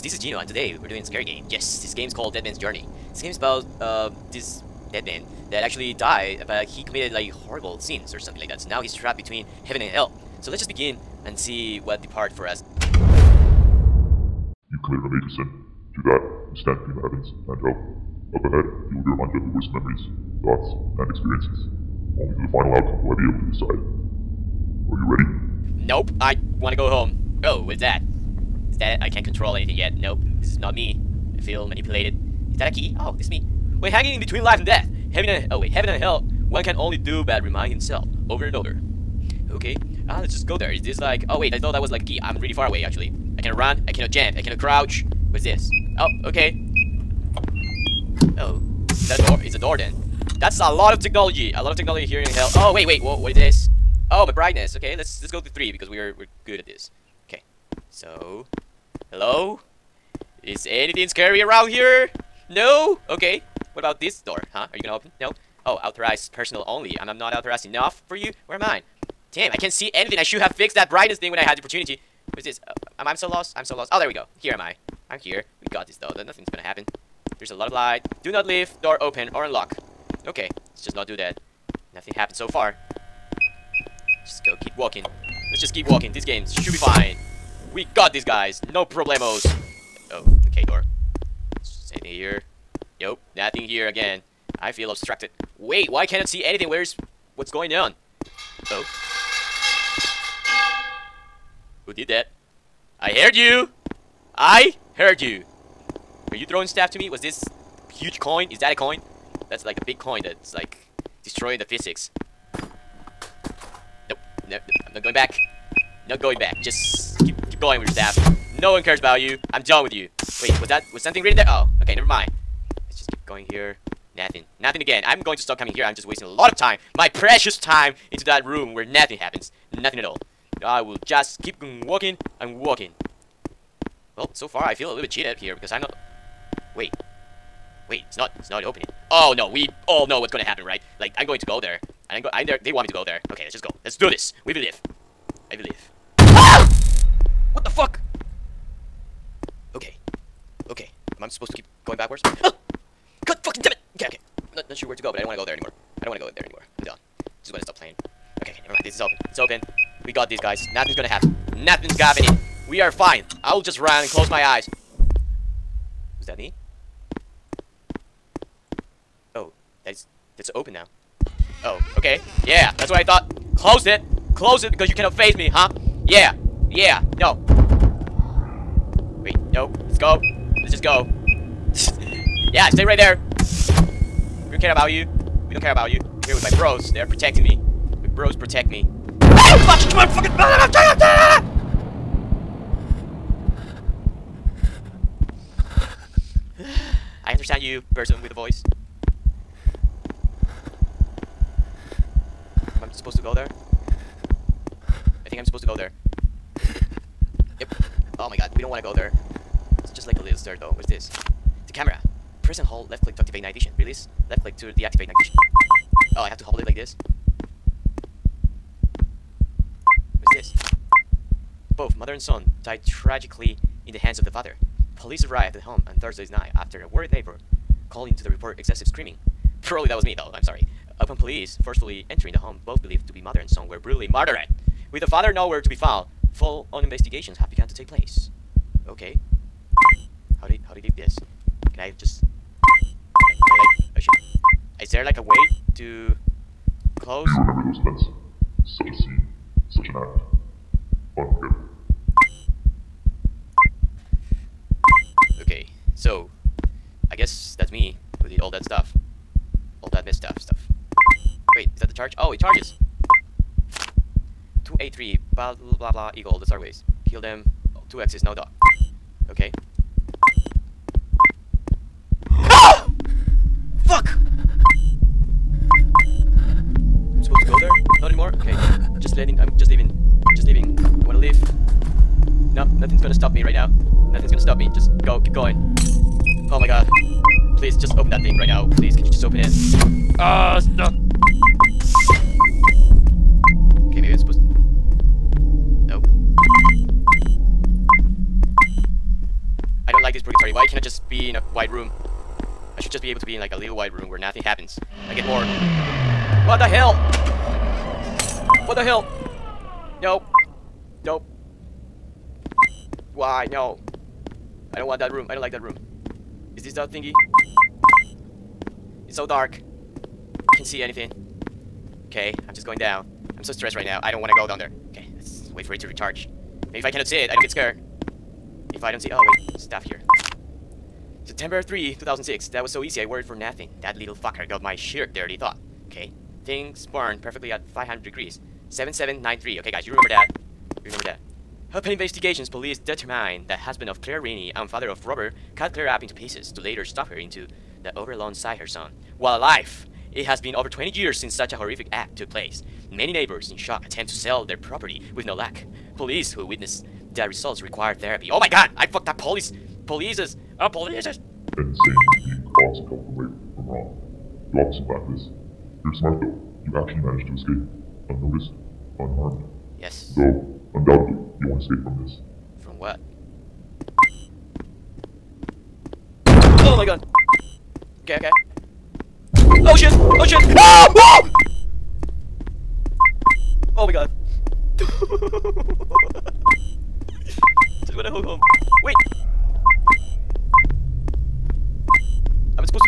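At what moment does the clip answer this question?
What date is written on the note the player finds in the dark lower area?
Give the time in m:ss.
5:31.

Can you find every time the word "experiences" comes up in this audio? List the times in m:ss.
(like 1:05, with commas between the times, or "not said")
0:21.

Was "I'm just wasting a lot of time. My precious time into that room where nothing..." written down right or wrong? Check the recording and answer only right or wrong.
right.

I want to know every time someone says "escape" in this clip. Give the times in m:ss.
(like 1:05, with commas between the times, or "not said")
6:07, 6:11.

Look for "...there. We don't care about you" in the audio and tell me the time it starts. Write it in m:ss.
3:02.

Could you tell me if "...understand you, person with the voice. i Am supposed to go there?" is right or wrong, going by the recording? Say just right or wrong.
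right.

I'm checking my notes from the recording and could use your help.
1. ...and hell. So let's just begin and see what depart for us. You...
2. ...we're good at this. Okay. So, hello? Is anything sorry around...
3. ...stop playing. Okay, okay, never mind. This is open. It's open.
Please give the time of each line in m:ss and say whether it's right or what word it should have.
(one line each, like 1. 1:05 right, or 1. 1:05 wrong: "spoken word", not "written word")
1. 0:09 right
2. 0:56 wrong: "scary", not "sorry"
3. 2:37 right.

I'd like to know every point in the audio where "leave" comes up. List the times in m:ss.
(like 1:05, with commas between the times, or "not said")
1:18, 4:00.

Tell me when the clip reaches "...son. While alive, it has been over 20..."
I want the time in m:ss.
5:48.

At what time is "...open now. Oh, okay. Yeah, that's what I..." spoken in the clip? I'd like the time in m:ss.
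2:50.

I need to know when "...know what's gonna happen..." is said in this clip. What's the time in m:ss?
2:20.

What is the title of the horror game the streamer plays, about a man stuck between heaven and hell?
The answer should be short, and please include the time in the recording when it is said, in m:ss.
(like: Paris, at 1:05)
Dead Man's Journey, at 0:02.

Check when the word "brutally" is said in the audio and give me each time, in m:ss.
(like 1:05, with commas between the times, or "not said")
3:53.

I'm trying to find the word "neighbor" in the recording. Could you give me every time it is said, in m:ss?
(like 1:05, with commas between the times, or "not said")
3:47, 5:53.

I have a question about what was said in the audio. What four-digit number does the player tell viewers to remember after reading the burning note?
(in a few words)
7793.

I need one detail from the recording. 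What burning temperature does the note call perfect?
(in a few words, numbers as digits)
500 degrees.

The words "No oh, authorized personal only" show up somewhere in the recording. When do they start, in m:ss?
1:05.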